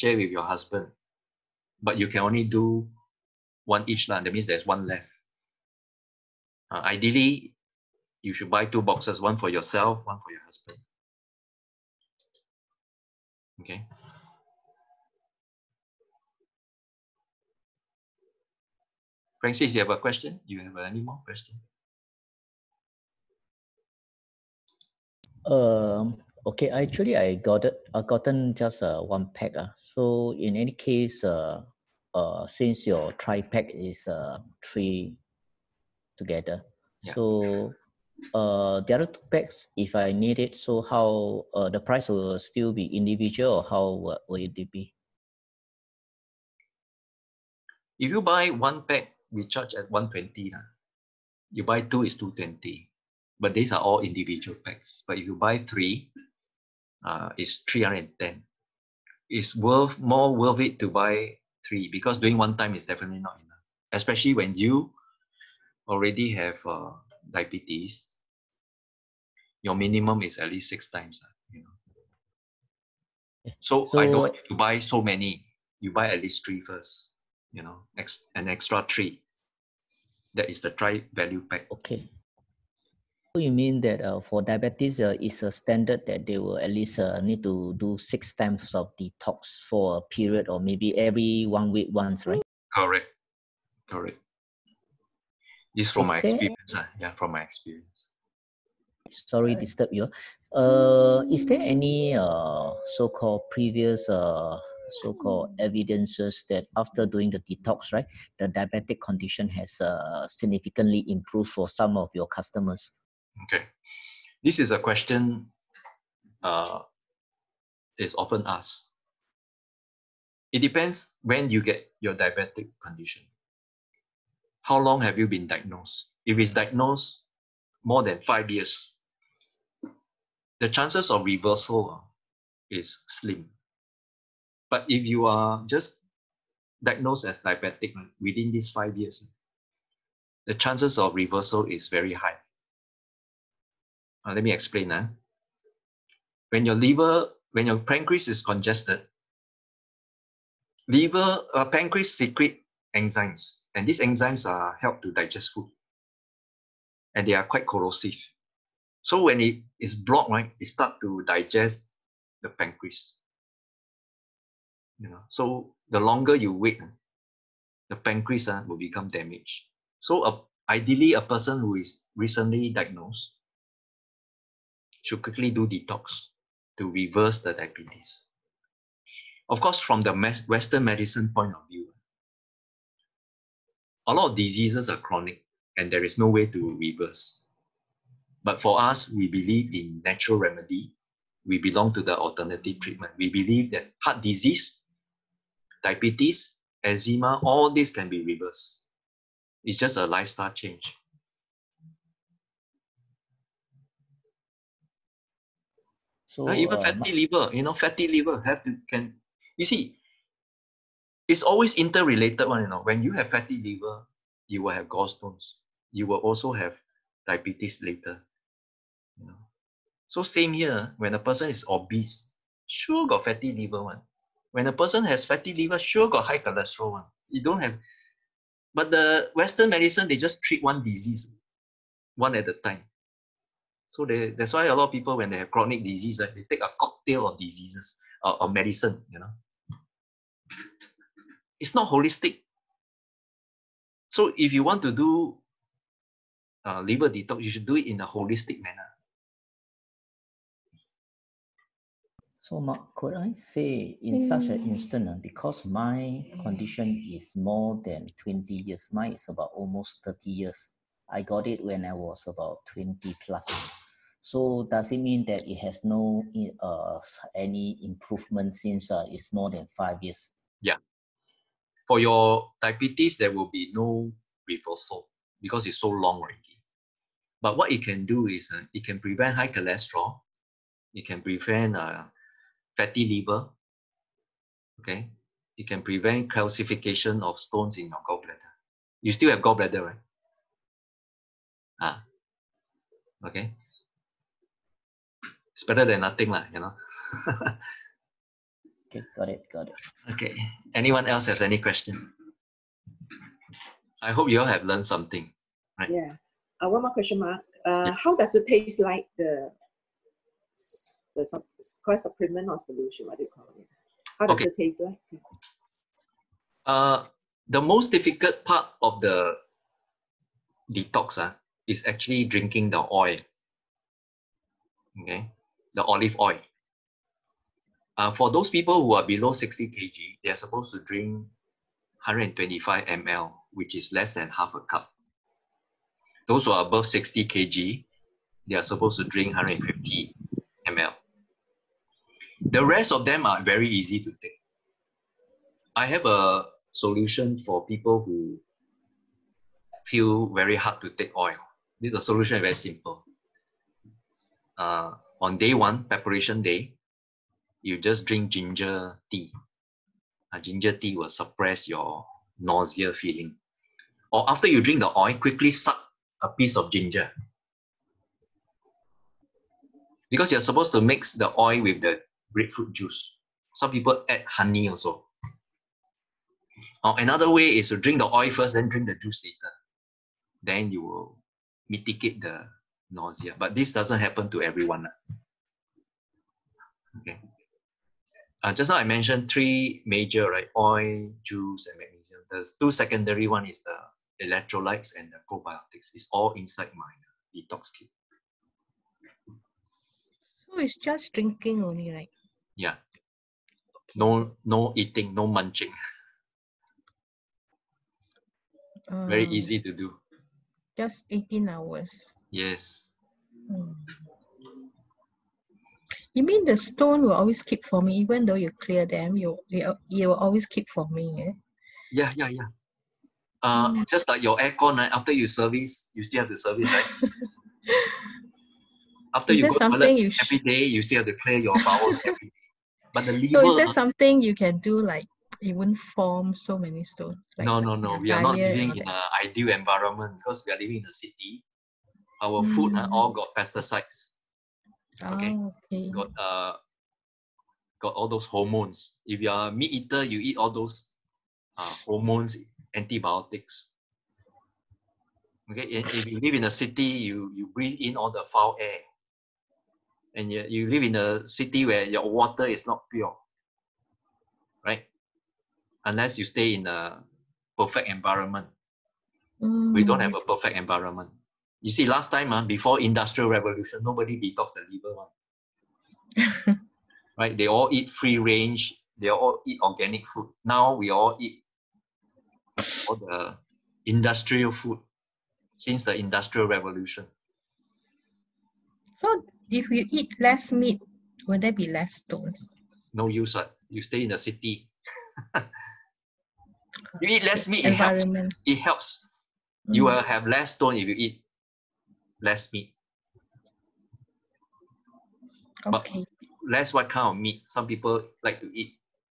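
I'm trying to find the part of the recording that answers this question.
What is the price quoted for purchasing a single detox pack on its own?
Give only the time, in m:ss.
0:49.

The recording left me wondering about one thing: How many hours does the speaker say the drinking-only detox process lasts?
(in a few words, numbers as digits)
18.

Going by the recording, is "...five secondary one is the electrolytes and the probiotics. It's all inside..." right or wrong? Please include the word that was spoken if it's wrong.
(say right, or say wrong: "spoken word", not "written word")
wrong: "two", not "five".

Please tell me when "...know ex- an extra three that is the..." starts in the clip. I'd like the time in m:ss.
1:17.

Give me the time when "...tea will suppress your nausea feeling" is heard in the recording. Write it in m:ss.
6:00.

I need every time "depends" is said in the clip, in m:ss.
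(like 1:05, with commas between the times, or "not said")
2:00.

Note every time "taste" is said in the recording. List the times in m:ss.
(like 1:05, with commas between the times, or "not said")
5:08, 5:14.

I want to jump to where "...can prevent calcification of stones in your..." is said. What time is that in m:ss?
4:45.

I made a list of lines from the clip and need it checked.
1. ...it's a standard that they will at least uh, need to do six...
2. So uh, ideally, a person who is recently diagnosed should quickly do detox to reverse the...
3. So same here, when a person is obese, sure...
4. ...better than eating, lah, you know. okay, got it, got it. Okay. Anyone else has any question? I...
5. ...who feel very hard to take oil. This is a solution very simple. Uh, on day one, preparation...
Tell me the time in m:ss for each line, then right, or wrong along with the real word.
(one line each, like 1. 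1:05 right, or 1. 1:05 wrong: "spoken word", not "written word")
1. 1:25 right
2. 2:49 right
3. 3:40 right
4. 4:55 wrong: "nothing", not "eating"
5. 5:48 right.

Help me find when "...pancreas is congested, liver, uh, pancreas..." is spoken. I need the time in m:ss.
2:27.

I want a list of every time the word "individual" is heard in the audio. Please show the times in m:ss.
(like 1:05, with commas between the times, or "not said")
0:42, 0:54.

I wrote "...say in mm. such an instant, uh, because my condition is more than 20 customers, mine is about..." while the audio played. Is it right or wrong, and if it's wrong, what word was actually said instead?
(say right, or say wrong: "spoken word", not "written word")
wrong: "years", not "customers".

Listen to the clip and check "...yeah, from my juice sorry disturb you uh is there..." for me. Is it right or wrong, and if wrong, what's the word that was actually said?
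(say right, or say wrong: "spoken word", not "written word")
wrong: "experience", not "juice".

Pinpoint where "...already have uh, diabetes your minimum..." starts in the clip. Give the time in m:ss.
1:05.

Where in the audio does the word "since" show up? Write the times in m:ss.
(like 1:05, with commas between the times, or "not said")
0:32, 4:28, 8:05.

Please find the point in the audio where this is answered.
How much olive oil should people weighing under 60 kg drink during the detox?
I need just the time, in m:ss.
5:32.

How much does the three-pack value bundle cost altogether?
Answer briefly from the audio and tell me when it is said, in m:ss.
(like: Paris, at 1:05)
310, at 0:57.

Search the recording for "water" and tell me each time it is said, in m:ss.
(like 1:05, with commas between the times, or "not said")
7:42.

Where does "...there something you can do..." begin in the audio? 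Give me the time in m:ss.
7:13.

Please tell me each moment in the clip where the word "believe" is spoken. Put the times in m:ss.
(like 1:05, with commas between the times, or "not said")
3:09, 3:13.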